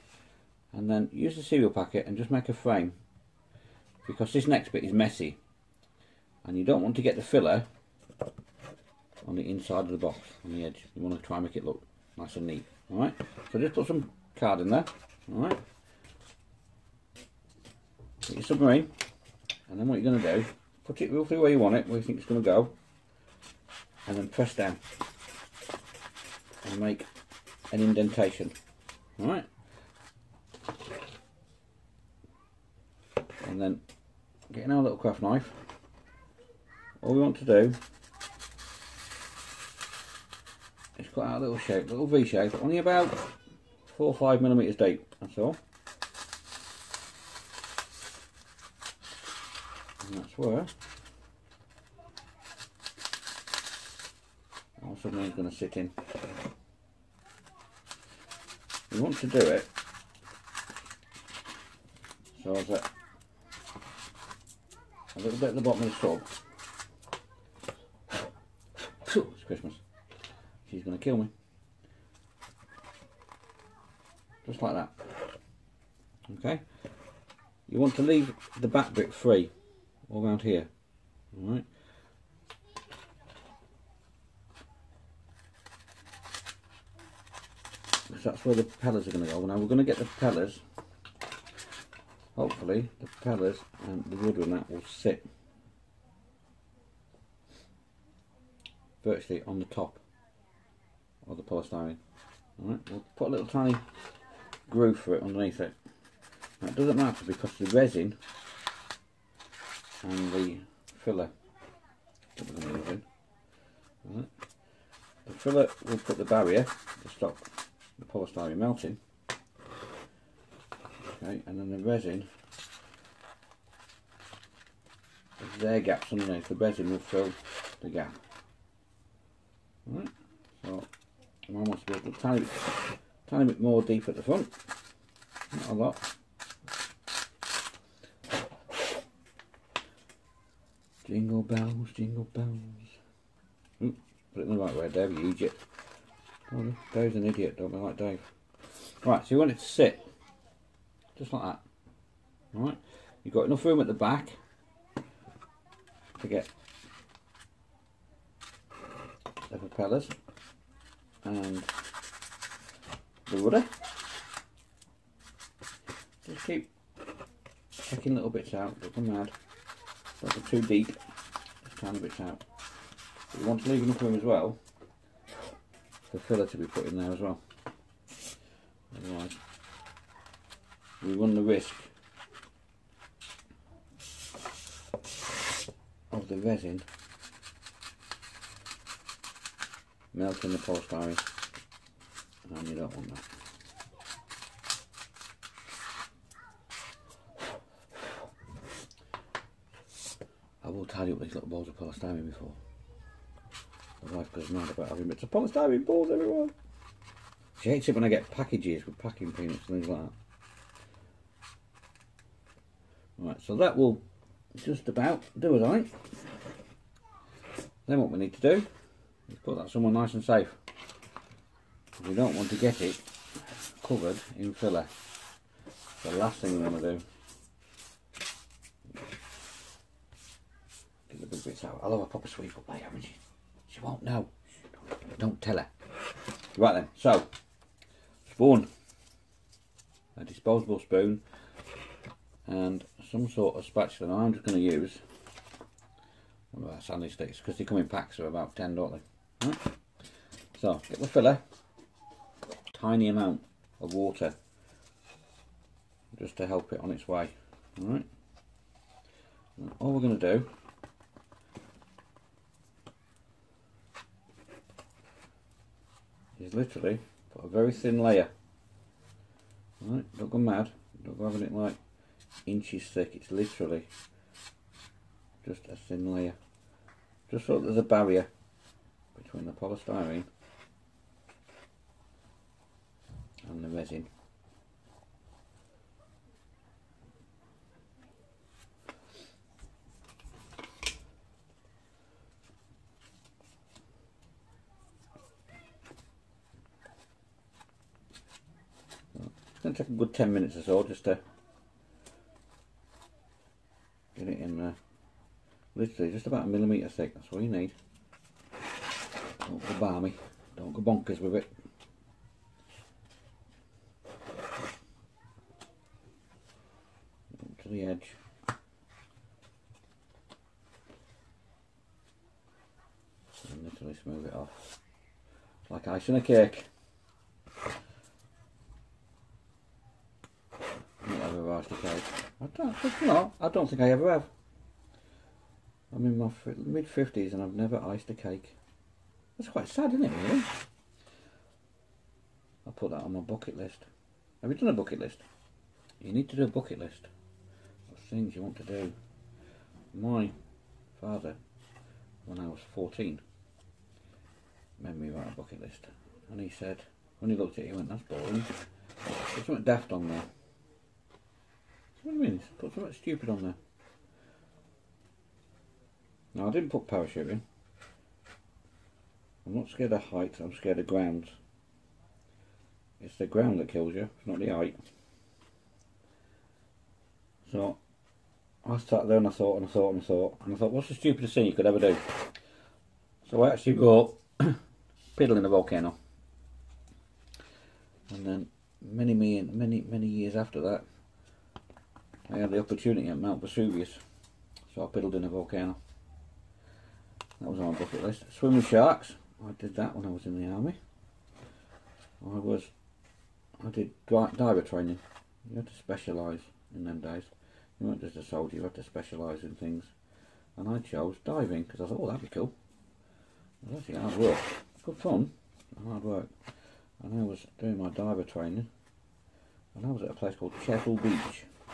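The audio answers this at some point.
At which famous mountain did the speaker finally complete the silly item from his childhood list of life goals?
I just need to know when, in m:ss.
6:33.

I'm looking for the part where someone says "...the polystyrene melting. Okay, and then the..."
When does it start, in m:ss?
1:57.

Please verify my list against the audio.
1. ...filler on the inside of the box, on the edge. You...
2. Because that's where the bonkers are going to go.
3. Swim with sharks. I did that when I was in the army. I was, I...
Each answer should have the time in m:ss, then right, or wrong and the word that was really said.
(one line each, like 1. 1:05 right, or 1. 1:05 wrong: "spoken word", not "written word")
1. 0:07 right
2. 1:28 wrong: "propellers", not "bonkers"
3. 6:38 right.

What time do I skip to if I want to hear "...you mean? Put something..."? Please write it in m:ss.
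6:02.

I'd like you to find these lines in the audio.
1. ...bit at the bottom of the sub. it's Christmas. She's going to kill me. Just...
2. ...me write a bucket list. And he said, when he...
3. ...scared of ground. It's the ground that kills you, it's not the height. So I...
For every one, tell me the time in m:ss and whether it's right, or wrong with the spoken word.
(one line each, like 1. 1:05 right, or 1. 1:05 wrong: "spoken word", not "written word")
1. 1:05 right
2. 5:55 right
3. 6:10 right.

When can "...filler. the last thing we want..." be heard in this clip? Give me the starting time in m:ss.
3:44.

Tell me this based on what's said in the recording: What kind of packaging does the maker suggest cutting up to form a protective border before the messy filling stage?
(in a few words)
Cereal packet.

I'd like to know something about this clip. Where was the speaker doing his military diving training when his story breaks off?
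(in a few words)
Chesil Beach.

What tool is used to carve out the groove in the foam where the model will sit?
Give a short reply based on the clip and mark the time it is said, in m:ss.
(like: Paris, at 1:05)
Craft knife, at 0:34.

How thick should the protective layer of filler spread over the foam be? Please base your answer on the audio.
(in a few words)
1 millimetre.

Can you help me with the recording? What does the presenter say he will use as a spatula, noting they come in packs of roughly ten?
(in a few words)
Sandy sticks.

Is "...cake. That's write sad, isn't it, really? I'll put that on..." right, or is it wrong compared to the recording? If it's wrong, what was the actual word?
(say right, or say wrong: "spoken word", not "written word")
wrong: "quite", not "write".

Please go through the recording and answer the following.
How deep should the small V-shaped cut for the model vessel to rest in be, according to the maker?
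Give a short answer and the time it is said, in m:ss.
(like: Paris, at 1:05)
4 or 5 millimeters, at 0:43.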